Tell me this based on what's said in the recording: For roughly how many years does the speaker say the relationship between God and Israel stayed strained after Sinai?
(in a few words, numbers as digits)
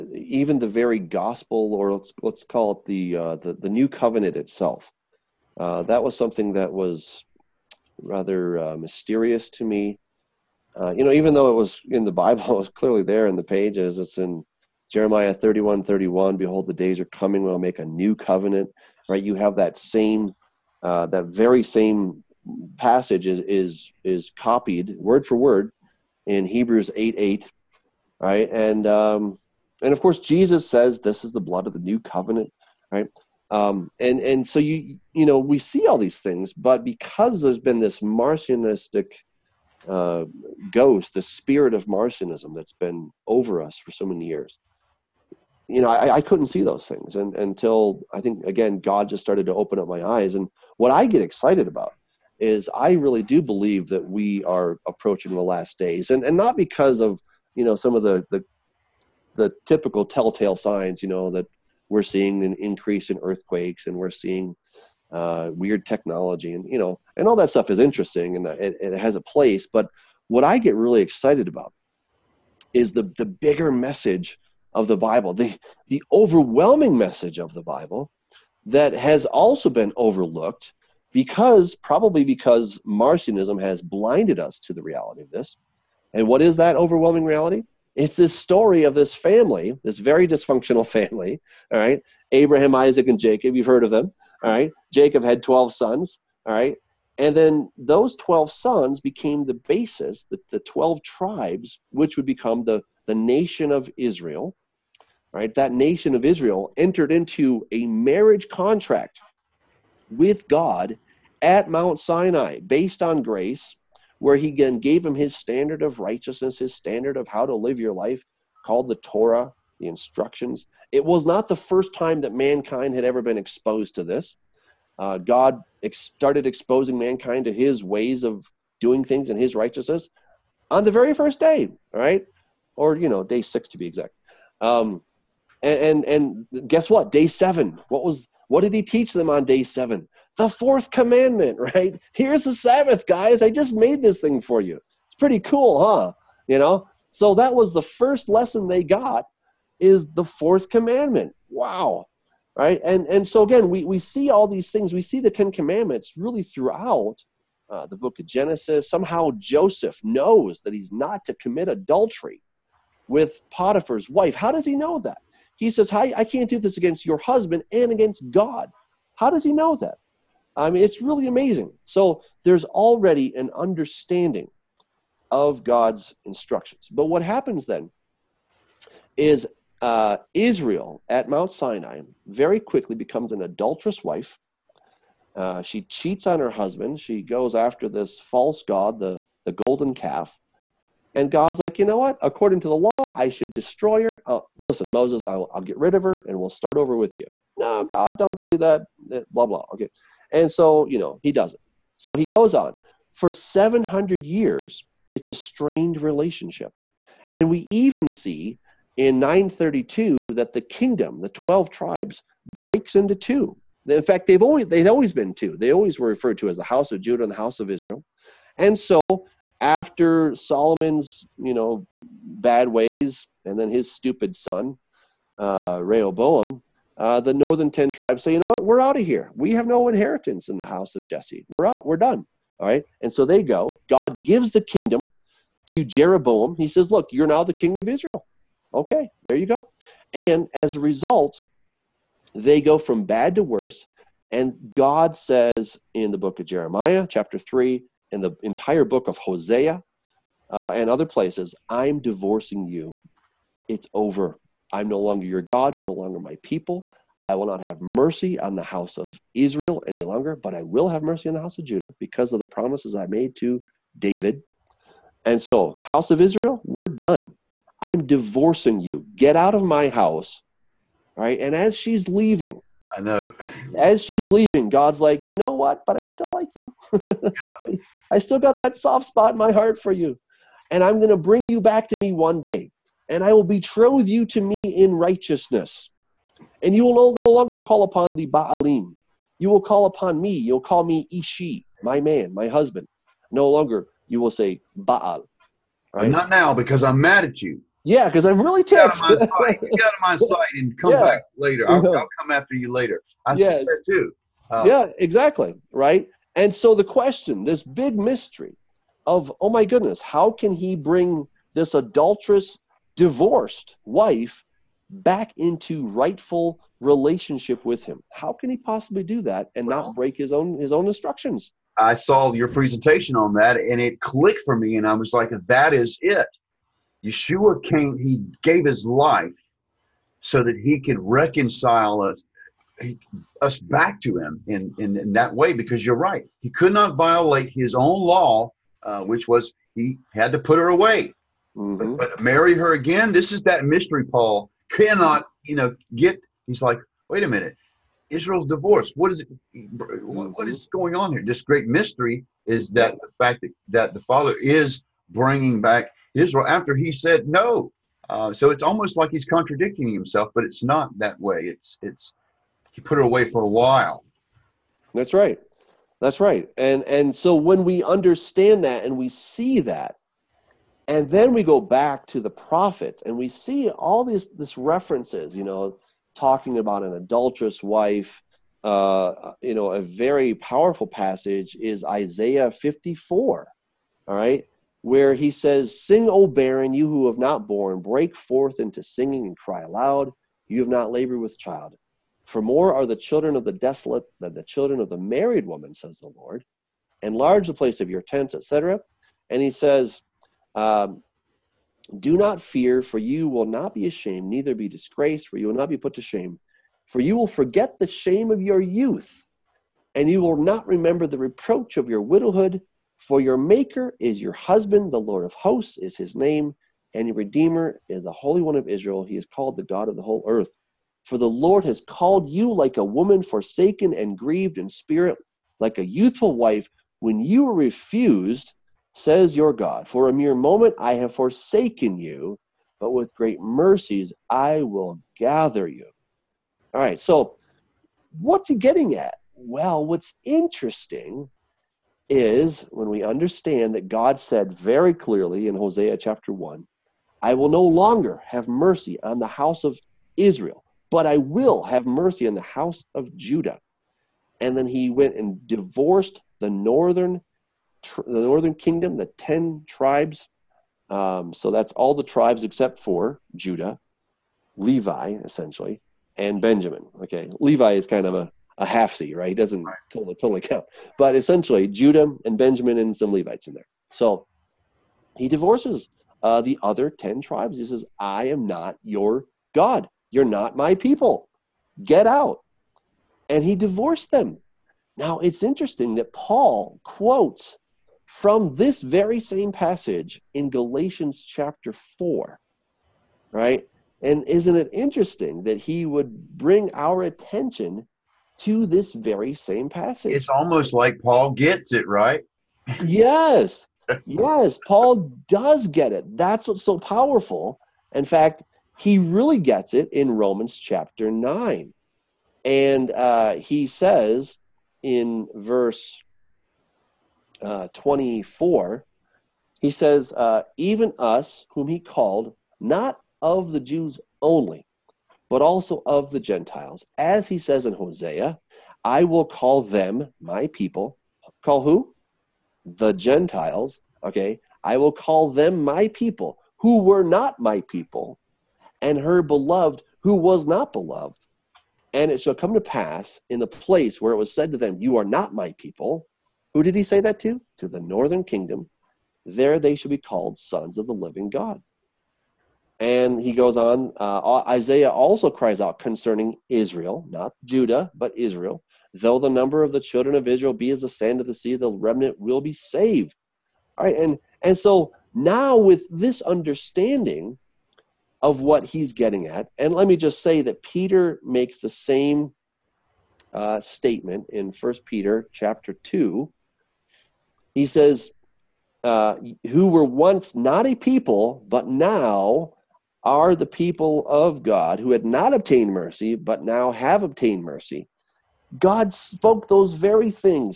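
700.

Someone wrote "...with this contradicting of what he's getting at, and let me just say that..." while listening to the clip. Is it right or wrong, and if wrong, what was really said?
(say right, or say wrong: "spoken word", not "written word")
wrong: "understanding", not "contradicting".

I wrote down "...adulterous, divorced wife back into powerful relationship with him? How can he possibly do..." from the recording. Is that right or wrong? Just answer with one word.
wrong.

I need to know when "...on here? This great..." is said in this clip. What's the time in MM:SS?
05:50.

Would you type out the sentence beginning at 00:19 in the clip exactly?
You have that same, uh, that very same passage is, is, is copied word for word in Hebrews 8 8, right?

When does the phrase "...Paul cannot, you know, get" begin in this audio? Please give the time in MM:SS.
05:44.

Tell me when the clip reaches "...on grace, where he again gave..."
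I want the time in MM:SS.
01:53.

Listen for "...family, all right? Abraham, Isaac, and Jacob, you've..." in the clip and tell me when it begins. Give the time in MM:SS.
01:30.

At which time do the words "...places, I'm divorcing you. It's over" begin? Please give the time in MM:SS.
04:11.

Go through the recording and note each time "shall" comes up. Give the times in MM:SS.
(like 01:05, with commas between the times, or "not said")
09:02, 09:09.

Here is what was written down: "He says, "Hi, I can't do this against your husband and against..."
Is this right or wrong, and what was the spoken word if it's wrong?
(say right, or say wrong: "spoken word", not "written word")
right.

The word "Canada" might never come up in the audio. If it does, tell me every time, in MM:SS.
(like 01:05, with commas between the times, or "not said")
not said.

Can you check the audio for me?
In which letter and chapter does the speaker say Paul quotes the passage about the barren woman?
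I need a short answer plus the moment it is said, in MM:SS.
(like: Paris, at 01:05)
Galatians chapter 4, at 08:10.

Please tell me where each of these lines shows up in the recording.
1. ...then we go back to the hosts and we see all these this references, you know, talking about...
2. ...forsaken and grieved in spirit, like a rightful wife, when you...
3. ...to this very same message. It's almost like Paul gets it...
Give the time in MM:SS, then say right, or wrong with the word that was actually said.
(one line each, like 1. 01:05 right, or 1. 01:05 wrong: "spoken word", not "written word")
1. 06:11 wrong: "prophets", not "hosts"
2. 07:03 wrong: "youthful", not "rightful"
3. 08:18 wrong: "passage", not "message".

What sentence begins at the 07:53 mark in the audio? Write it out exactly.
So he divorces uh, the other ten tribes.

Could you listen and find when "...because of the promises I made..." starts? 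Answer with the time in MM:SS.
04:21.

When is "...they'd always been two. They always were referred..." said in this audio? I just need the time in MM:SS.
03:34.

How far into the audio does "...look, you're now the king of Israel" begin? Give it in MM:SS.
03:56.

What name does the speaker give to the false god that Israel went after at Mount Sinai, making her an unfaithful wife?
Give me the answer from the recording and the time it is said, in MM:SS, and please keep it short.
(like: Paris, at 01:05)
the golden calf, at 03:09.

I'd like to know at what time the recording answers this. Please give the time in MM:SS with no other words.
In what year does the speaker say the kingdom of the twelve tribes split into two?
03:29.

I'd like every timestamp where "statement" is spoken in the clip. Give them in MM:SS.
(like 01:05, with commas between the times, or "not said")
09:33.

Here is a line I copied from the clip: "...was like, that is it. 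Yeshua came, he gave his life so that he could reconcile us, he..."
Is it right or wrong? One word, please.
right.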